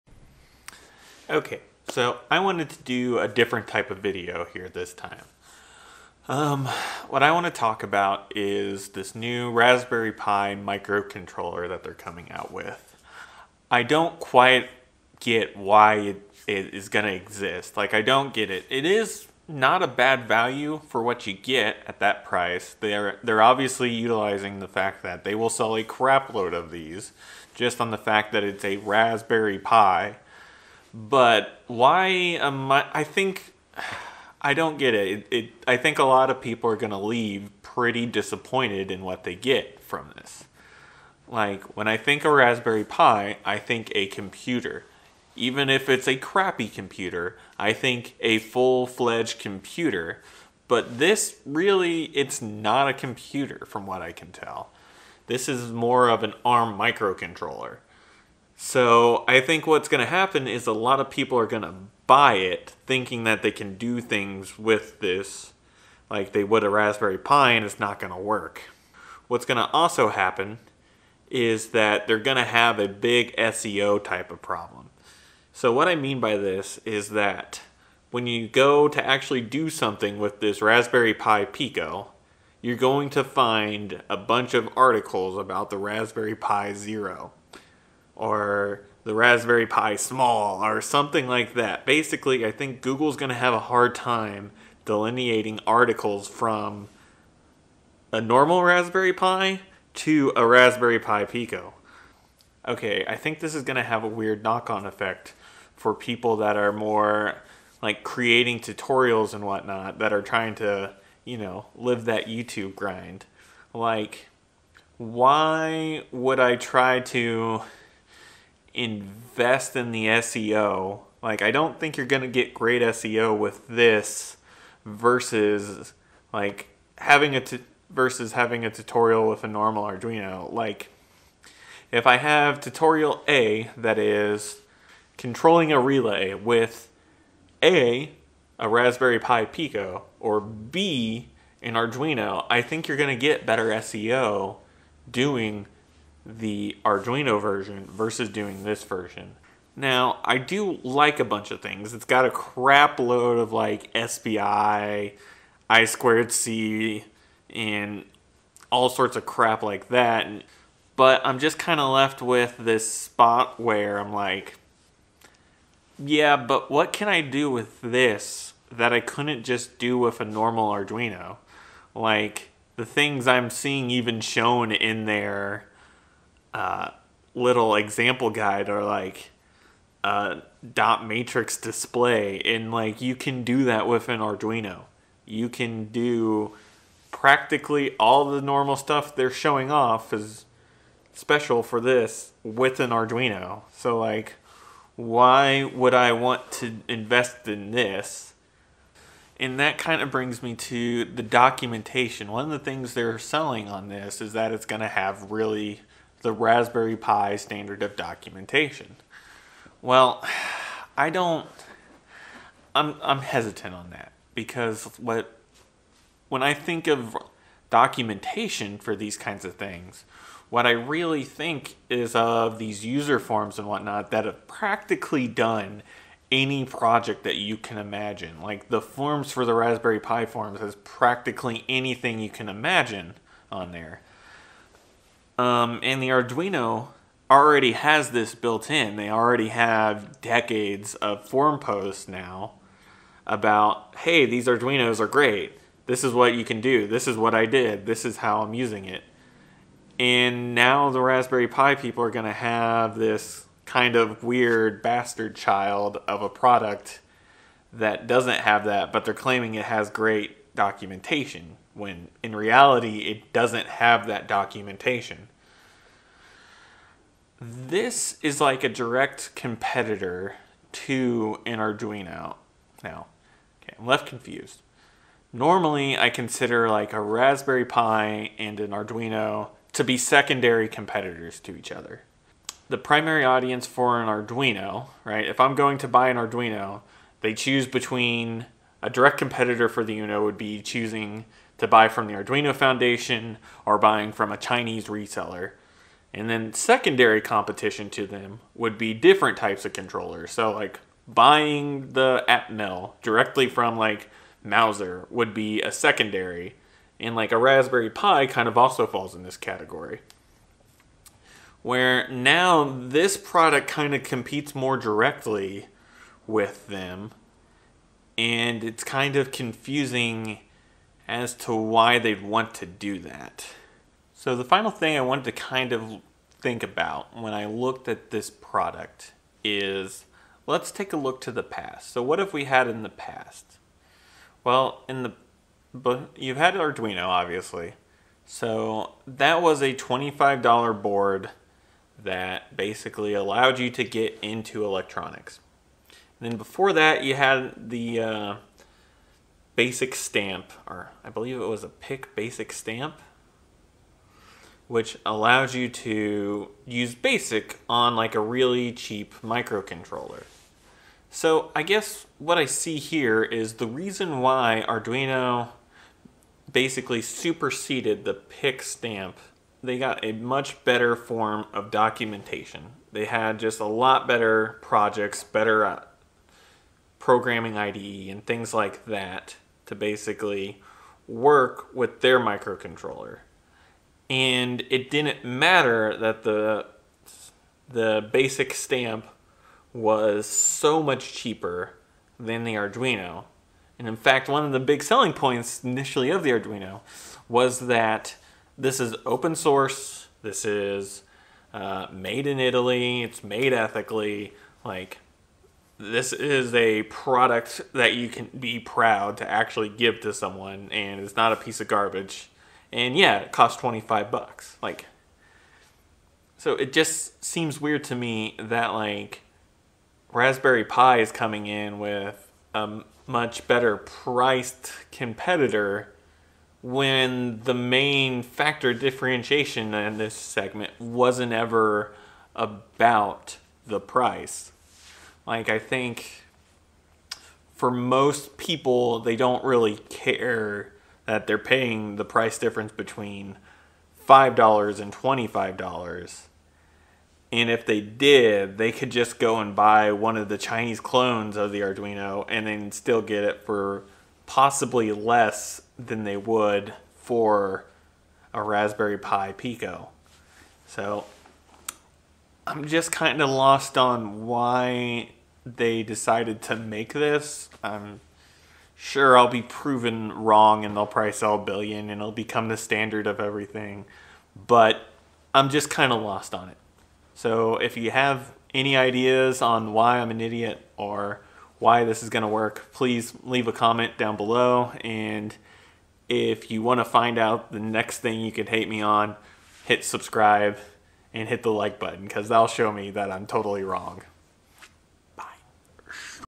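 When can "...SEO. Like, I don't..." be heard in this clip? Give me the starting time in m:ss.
2:00.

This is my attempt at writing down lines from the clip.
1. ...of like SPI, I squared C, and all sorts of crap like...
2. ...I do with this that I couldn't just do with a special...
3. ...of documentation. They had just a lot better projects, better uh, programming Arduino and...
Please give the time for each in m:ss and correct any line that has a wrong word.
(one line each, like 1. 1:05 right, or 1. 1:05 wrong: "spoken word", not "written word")
1. 2:33 right
2. 2:47 wrong: "normal", not "special"
3. 6:11 wrong: "IDE", not "Arduino".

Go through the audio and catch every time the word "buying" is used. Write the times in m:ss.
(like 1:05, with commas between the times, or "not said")
4:53, 5:01.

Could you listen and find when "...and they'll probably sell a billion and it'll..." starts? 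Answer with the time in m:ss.
7:50.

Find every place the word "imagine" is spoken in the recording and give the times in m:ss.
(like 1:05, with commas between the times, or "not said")
3:47, 3:52.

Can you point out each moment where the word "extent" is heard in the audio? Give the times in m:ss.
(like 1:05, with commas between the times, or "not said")
not said.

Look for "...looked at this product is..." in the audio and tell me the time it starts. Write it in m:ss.
5:27.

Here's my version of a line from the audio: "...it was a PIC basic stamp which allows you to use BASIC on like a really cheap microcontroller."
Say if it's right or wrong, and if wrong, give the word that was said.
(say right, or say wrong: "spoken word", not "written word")
right.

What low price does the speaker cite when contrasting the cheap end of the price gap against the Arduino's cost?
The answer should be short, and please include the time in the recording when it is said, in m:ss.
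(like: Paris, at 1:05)
$5, at 7:24.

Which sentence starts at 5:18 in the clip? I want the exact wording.
And it's kind of confusing as to why they'd want to do that.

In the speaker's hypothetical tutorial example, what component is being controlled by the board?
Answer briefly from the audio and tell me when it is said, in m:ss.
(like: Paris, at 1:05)
a relay, at 2:15.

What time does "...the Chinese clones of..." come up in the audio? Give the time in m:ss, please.
7:30.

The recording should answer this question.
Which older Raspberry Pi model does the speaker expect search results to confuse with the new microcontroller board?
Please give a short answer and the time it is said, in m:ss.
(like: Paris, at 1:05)
Raspberry Pi Zero, at 1:25.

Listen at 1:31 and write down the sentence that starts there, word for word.
Basically, I think Google's going to have a hard time delineating articles from a normal Raspberry Pi to a Raspberry Pi Pico.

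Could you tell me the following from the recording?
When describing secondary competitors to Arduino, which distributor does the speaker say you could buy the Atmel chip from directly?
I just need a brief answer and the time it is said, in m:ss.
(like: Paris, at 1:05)
Mouser, at 5:04.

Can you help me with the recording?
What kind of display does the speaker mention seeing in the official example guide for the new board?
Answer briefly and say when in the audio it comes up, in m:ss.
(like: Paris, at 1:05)
dot matrix display, at 3:00.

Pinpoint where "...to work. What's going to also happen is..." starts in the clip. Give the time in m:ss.
1:08.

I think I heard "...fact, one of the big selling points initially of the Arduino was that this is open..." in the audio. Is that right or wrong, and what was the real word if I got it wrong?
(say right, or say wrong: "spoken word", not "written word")
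right.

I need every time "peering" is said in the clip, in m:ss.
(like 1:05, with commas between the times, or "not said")
not said.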